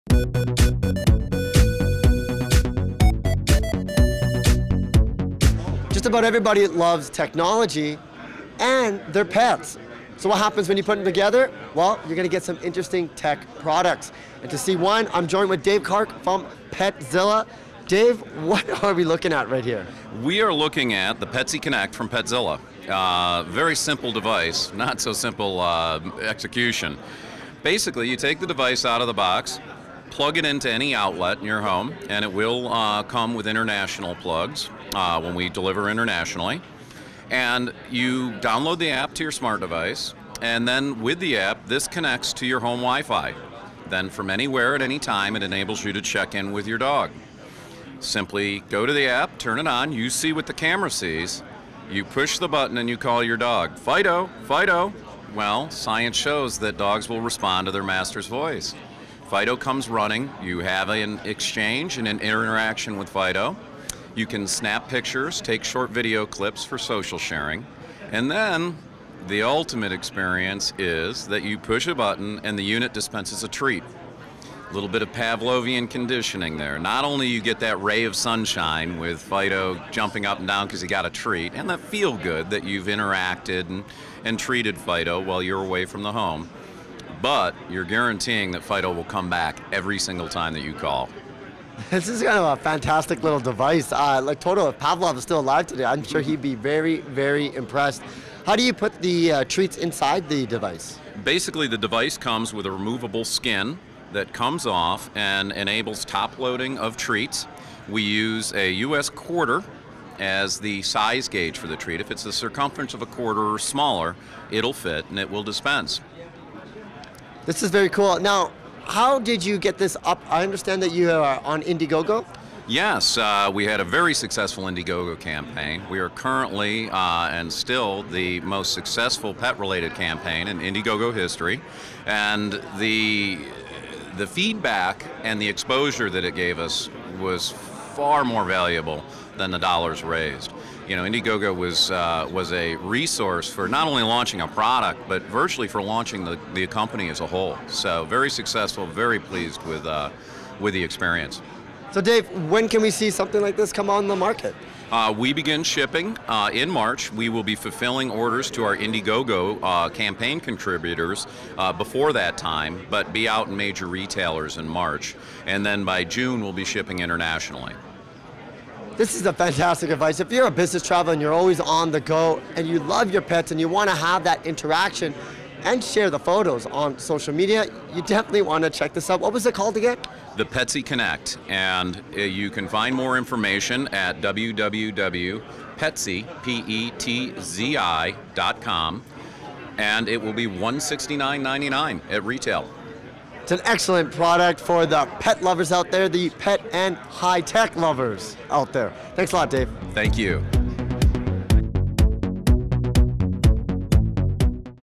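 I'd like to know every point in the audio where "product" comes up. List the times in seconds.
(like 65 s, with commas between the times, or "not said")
13 s, 144 s, 194 s.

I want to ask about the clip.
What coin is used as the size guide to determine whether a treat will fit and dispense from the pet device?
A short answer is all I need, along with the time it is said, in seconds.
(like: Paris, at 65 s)
U.S. quarter, at 108 s.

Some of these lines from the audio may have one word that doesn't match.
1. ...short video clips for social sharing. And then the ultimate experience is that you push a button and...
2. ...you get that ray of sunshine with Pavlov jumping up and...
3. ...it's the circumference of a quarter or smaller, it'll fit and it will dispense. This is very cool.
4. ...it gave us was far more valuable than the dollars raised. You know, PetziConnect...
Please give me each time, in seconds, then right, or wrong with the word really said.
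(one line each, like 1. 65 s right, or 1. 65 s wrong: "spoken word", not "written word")
1. 65 s right
2. 77 s wrong: "Fido", not "Pavlov"
3. 112 s right
4. 136 s wrong: "Indiegogo", not "PetziConnect".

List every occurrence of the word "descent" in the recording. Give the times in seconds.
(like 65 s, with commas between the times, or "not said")
not said.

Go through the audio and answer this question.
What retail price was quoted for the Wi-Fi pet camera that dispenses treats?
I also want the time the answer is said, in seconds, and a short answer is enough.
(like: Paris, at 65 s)
$169.99, at 190 s.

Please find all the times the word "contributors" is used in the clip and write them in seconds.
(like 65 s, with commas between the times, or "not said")
160 s.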